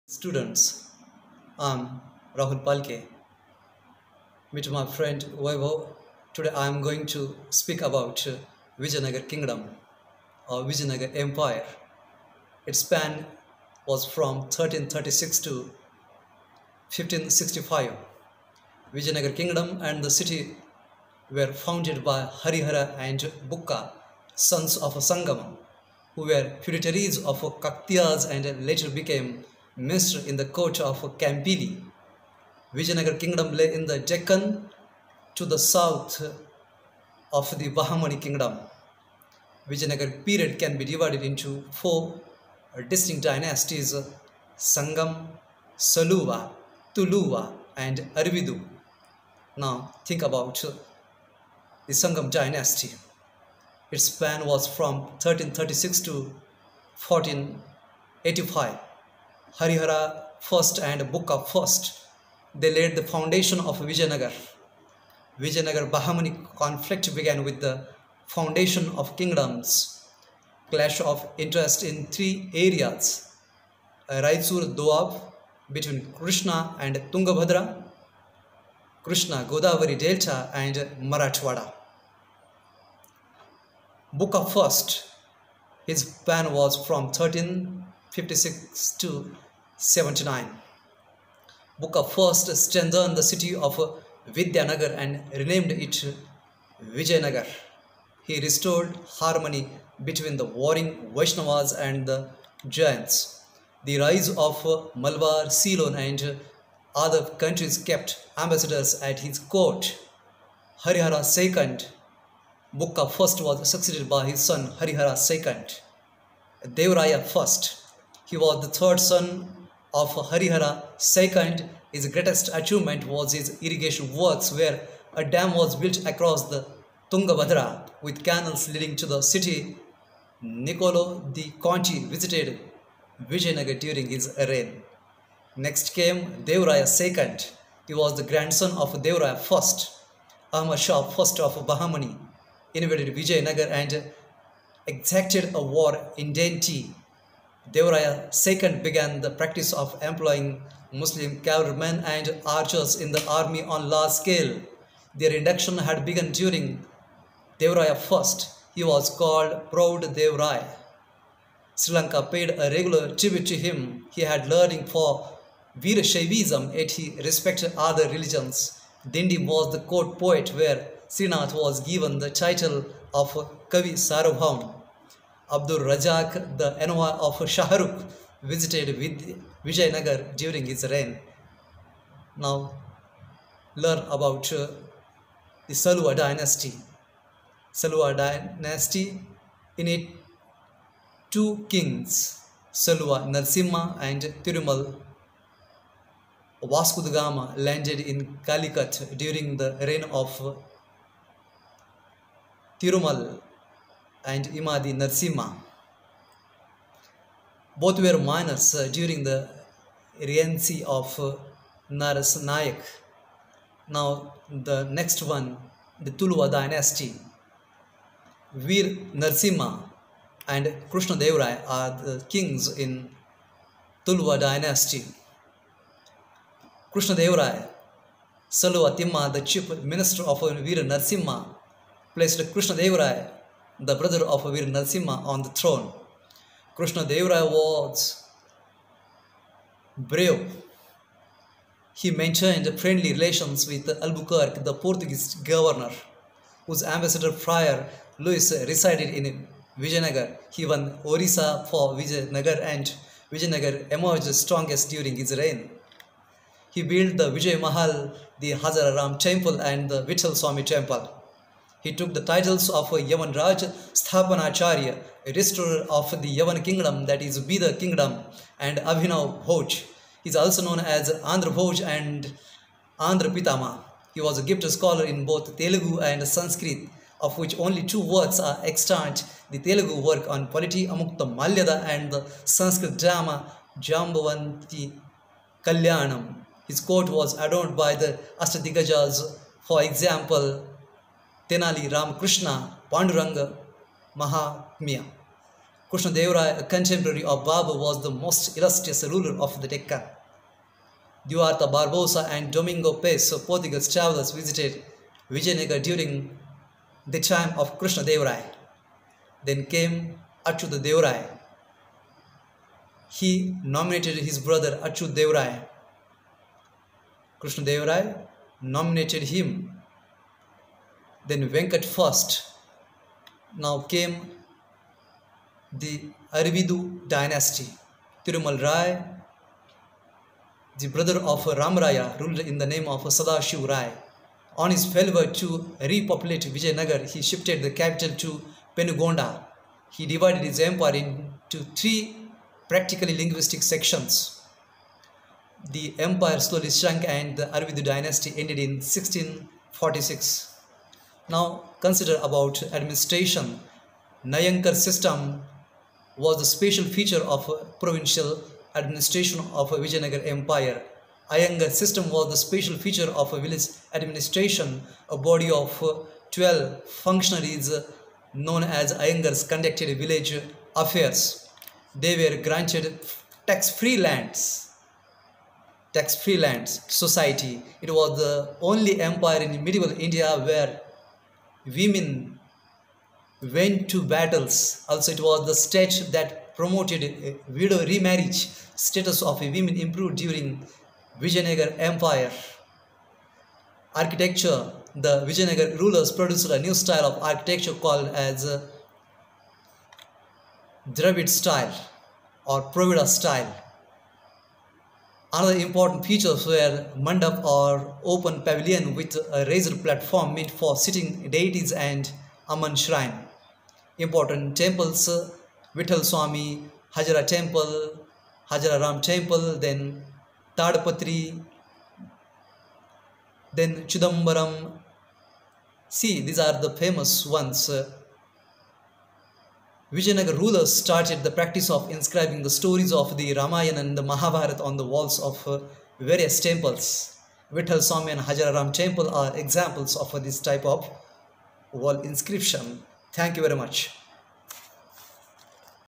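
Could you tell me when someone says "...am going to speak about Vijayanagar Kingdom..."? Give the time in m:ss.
0:06.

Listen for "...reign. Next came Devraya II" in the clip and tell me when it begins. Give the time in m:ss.
2:14.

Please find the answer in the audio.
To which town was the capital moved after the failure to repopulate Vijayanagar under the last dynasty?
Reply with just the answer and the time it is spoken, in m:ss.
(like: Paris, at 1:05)
Penugonda, at 5:38.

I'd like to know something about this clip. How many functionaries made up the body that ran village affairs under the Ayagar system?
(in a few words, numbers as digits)
12.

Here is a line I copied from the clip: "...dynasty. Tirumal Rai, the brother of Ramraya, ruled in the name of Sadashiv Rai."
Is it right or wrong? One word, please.
right.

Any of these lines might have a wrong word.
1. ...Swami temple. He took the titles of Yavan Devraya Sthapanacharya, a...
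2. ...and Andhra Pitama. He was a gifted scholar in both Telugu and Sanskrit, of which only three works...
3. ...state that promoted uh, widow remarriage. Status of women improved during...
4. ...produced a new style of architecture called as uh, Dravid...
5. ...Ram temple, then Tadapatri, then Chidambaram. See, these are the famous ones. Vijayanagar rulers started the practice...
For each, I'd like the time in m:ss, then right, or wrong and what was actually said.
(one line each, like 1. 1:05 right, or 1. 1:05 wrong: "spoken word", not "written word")
1. 4:20 wrong: "Raj", not "Devraya"
2. 4:31 wrong: "two", not "three"
3. 6:25 right
4. 6:36 right
5. 6:58 right.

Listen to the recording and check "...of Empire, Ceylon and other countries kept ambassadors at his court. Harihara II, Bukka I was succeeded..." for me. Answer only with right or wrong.
wrong.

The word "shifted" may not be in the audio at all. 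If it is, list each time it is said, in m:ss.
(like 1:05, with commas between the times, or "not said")
5:37.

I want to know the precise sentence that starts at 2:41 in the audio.
Sri Lanka paid a regular tribute to him.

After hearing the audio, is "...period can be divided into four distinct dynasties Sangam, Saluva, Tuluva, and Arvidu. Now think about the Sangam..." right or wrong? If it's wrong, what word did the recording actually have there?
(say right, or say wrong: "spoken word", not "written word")
right.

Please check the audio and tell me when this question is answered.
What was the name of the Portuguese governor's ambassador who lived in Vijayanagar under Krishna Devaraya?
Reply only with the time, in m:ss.
4:08.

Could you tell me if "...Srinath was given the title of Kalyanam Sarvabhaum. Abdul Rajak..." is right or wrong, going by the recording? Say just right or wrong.
wrong.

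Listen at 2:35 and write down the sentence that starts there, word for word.
Their induction had begun during Devraya I.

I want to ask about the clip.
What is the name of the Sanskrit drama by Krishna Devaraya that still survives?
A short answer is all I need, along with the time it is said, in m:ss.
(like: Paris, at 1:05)
Jambavanti Kalyanam, at 4:43.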